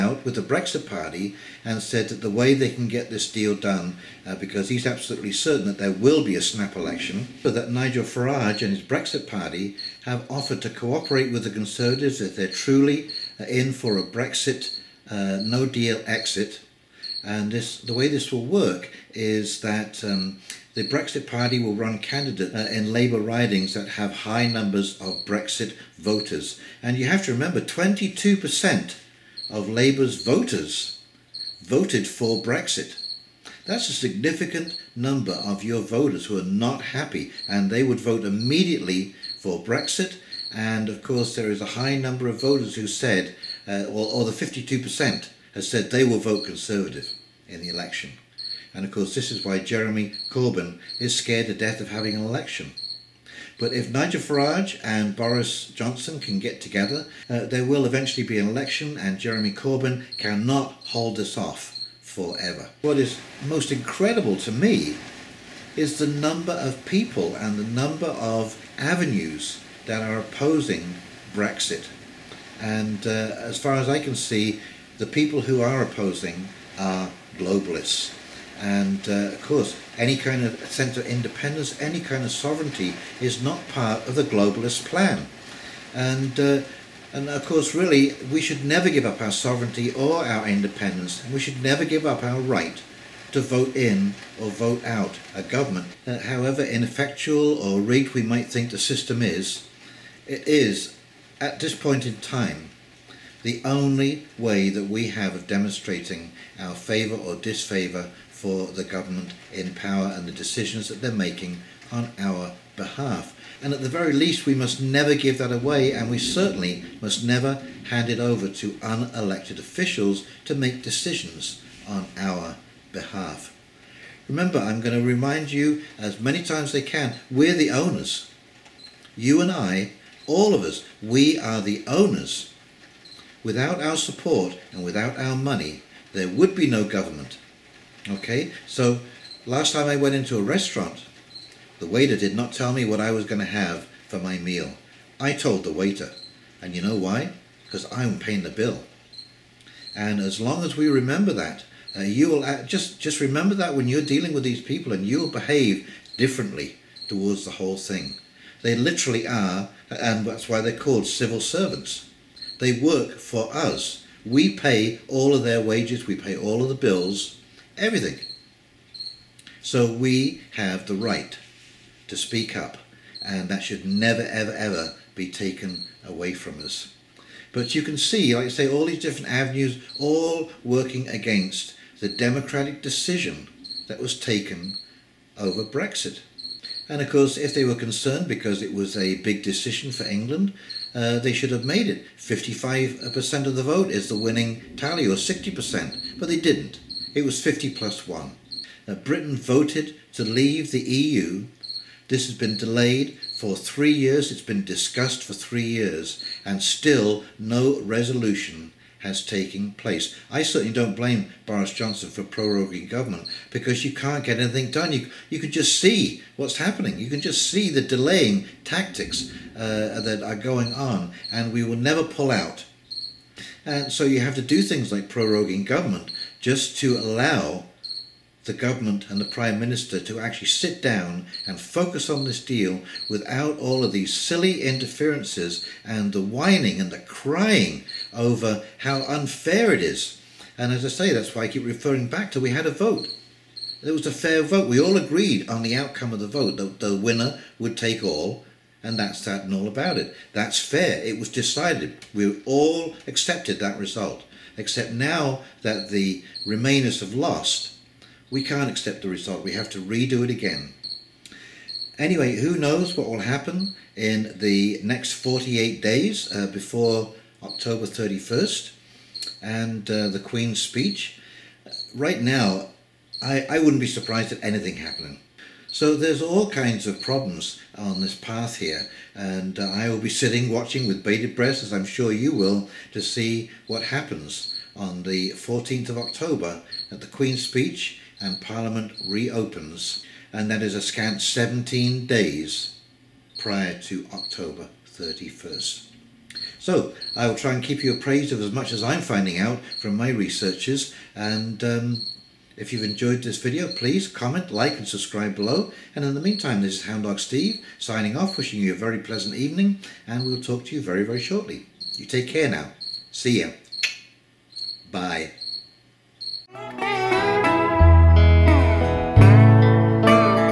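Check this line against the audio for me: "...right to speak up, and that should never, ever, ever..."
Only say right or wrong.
right.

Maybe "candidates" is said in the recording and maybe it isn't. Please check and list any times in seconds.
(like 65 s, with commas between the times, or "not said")
21 s.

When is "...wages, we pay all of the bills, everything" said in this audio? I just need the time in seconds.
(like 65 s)
165 s.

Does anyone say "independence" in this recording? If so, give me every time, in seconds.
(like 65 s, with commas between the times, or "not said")
81 s, 90 s.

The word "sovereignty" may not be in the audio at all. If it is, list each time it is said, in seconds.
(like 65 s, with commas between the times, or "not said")
82 s, 89 s.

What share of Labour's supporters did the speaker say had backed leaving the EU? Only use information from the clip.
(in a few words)
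22%.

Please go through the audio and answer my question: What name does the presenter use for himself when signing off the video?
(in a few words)
Hound Dog Steve.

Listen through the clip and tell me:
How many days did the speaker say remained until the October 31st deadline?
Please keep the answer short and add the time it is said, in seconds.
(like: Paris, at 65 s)
48, at 265 s.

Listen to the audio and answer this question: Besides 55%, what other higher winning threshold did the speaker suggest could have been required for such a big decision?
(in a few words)
60%.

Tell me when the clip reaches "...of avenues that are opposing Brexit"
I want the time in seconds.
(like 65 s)
68 s.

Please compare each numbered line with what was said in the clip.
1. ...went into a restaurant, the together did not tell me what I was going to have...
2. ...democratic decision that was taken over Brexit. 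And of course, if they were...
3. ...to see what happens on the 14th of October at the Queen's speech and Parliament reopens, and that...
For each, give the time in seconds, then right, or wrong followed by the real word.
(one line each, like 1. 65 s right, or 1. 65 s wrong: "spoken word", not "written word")
1. 139 s wrong: "waiter", not "together"
2. 182 s right
3. 282 s right.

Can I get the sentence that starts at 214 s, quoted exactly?
You, you can just see what's happening.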